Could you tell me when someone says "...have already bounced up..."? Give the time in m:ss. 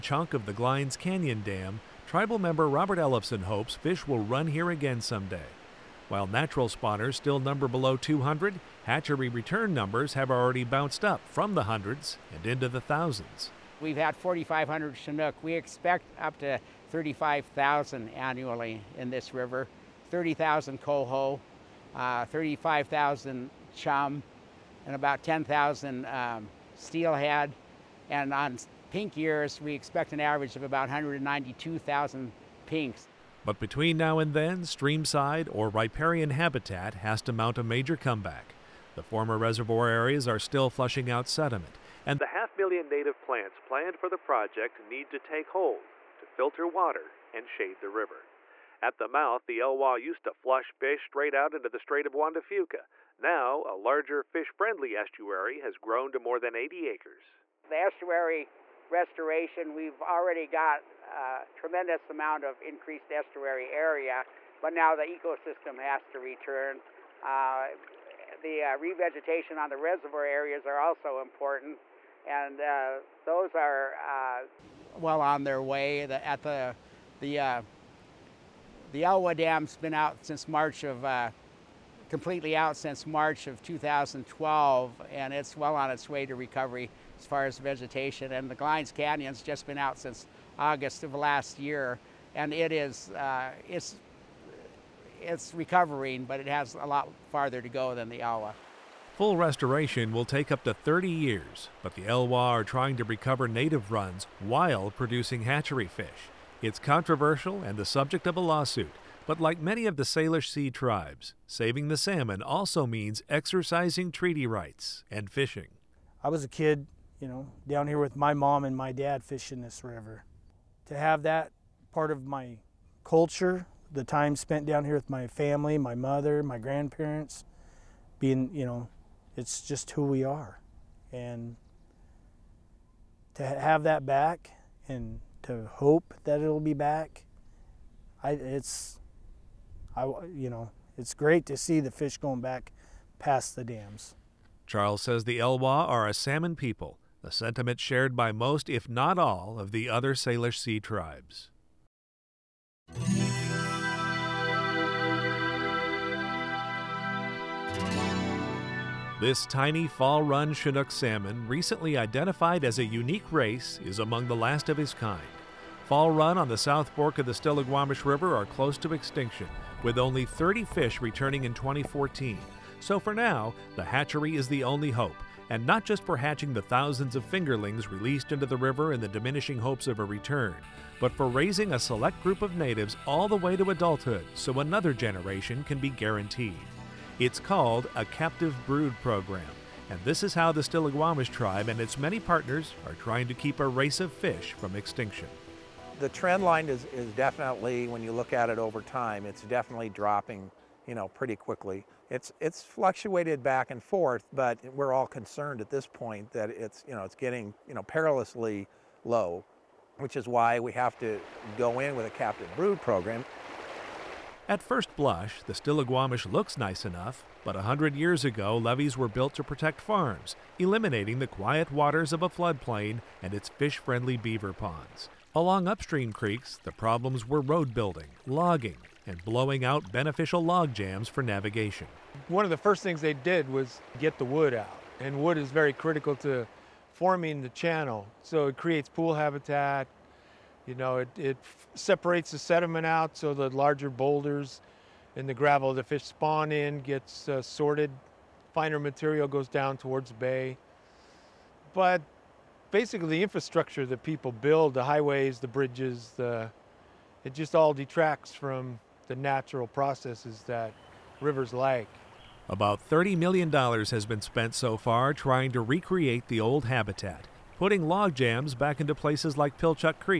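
0:10.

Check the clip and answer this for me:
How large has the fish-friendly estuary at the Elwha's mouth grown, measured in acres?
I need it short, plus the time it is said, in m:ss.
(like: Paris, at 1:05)
more than 80 acres, at 0:56.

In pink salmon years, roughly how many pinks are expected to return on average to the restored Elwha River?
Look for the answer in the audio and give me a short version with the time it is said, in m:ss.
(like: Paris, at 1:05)
192,000, at 0:30.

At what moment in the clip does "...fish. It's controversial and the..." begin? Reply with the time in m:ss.
1:45.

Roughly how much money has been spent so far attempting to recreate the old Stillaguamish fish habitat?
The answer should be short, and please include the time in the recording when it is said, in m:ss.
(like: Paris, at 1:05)
$30 million, at 4:22.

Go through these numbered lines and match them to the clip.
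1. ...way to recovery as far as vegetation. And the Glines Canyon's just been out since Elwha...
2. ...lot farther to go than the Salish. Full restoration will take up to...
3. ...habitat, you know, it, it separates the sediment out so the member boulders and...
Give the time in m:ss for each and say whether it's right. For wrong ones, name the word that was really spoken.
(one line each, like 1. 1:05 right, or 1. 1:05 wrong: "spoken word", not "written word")
1. 1:26 wrong: "August", not "Elwha"
2. 1:36 wrong: "Elwha", not "Salish"
3. 3:59 wrong: "larger", not "member".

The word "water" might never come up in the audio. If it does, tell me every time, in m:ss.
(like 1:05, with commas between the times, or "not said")
0:46, 3:41.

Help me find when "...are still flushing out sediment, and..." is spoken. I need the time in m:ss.
0:40.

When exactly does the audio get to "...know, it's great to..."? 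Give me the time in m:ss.
2:20.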